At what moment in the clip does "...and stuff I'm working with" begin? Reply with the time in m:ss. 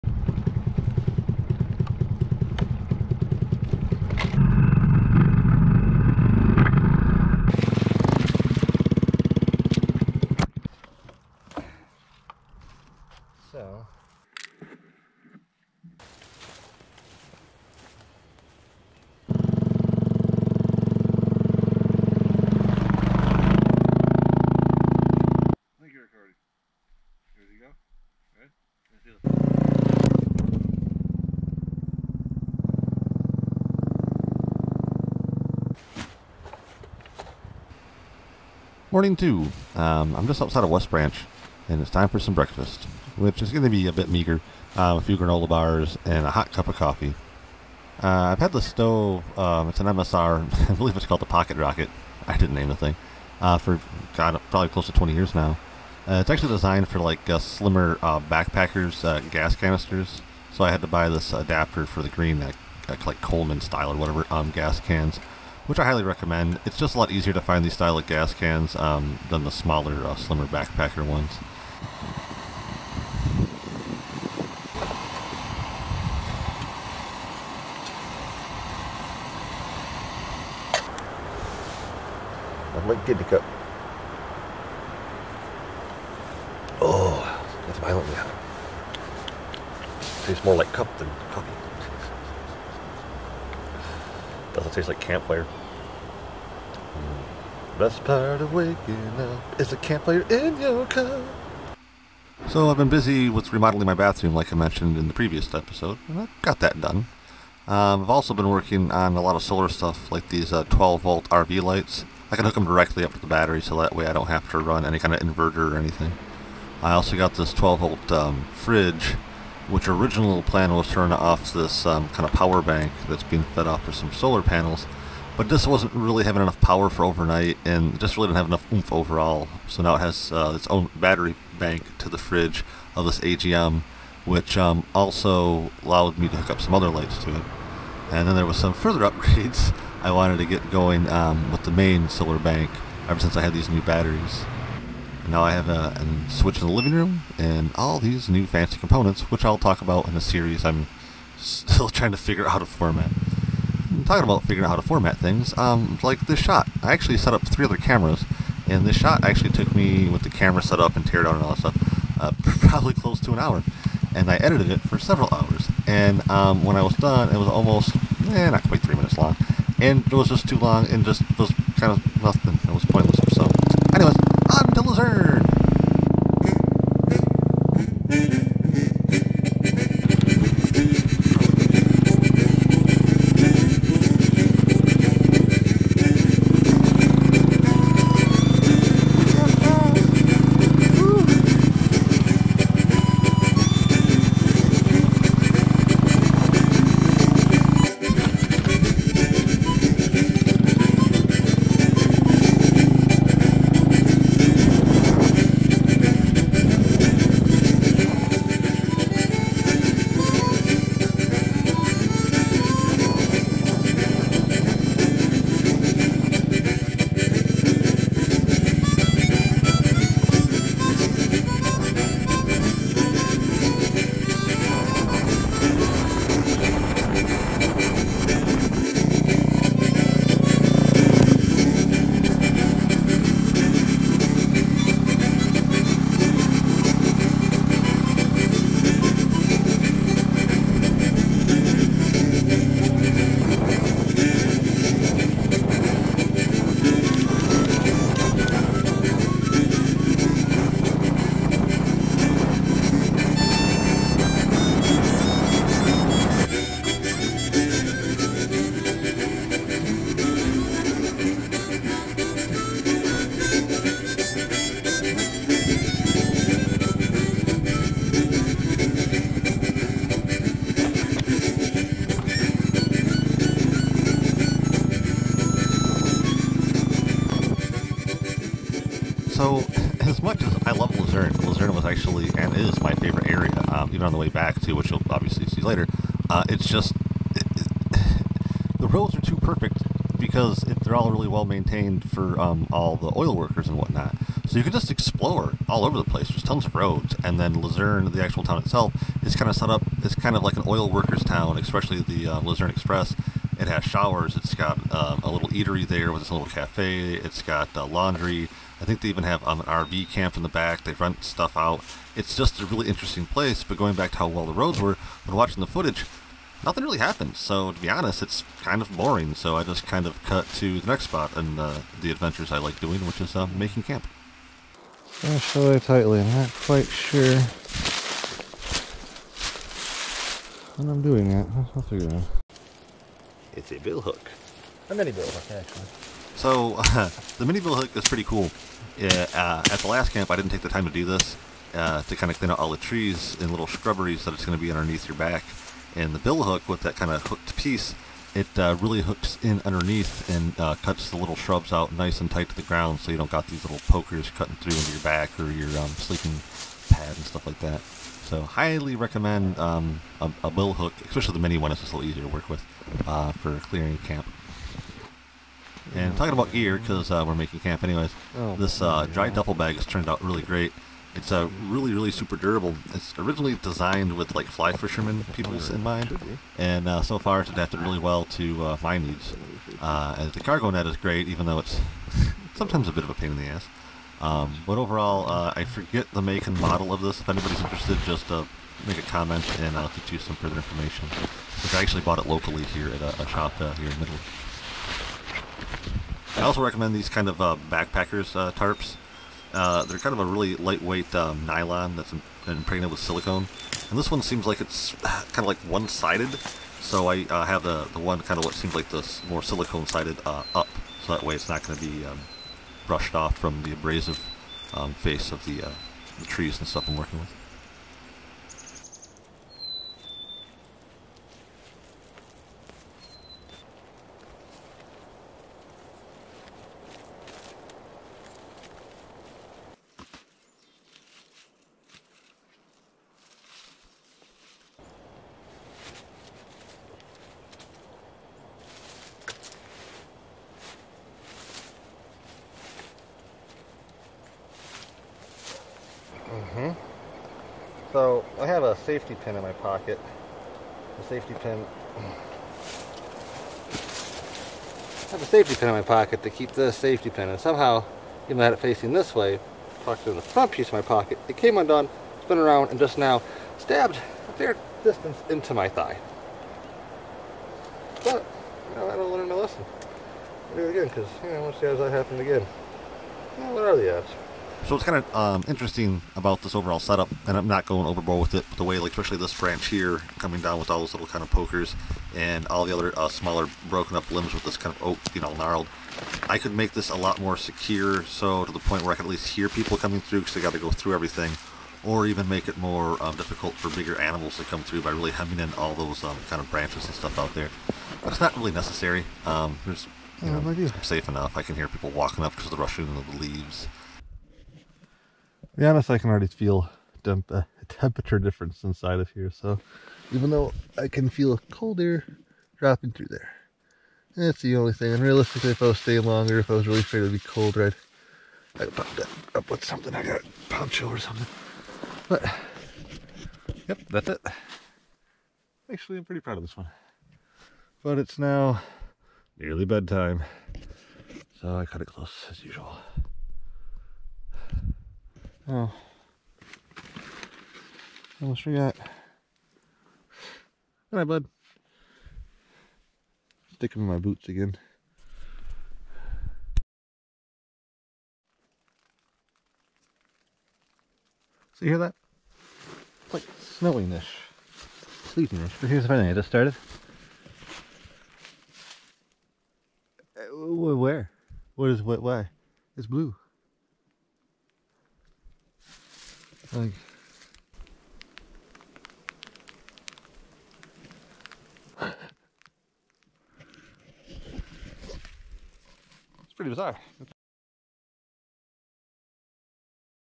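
6:56.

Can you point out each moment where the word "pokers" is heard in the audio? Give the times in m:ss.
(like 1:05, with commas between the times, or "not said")
5:53, 8:01.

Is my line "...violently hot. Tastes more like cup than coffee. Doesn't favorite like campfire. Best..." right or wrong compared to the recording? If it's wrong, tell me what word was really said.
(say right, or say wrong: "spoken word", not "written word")
wrong: "taste", not "favorite".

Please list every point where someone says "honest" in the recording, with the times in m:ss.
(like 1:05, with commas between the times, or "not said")
5:17, 8:25.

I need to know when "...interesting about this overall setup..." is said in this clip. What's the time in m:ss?
7:55.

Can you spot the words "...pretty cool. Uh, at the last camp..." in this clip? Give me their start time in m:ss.
5:38.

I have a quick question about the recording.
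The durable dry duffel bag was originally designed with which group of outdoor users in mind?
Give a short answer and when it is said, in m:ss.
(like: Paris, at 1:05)
fly fishermen, at 6:14.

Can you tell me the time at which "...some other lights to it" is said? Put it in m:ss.
2:16.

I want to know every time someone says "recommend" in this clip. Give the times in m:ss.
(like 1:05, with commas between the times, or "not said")
1:06, 5:58, 6:36.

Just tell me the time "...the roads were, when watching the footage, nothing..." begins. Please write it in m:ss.
5:14.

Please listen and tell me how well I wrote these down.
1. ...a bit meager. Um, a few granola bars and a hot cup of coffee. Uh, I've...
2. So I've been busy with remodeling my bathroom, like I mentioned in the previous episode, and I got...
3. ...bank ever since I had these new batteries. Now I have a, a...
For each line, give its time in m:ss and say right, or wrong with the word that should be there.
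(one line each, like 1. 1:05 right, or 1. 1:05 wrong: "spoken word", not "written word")
1. 0:43 right
2. 1:42 right
3. 2:22 right.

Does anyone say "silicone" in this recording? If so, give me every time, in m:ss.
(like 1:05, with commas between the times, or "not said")
6:42, 6:49.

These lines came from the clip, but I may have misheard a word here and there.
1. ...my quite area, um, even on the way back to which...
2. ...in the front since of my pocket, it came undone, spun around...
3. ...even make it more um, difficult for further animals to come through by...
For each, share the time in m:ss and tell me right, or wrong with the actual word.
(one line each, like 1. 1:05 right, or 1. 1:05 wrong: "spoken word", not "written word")
1. 4:42 wrong: "favorite", not "quite"
2. 7:40 wrong: "piece", not "since"
3. 8:12 wrong: "bigger", not "further".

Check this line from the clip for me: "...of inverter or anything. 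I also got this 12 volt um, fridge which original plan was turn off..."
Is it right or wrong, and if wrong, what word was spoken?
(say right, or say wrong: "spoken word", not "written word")
right.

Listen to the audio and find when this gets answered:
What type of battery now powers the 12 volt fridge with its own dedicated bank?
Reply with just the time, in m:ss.
2:13.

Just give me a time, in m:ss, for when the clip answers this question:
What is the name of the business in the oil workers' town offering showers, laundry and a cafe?
5:02.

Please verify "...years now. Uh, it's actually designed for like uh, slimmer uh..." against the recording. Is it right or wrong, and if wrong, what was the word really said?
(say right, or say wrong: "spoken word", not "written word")
right.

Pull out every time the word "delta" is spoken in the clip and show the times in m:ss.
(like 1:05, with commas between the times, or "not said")
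not said.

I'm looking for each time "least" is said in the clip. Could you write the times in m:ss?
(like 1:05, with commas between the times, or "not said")
8:09.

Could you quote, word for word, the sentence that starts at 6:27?
If anybody's interested, just uh, make a comment and I'll get you some further information.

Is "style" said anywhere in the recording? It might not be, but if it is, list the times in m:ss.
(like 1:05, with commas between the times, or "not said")
1:03, 1:07.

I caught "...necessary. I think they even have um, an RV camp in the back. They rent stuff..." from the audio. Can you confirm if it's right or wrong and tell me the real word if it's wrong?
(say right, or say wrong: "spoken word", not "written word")
wrong: "laundry", not "necessary".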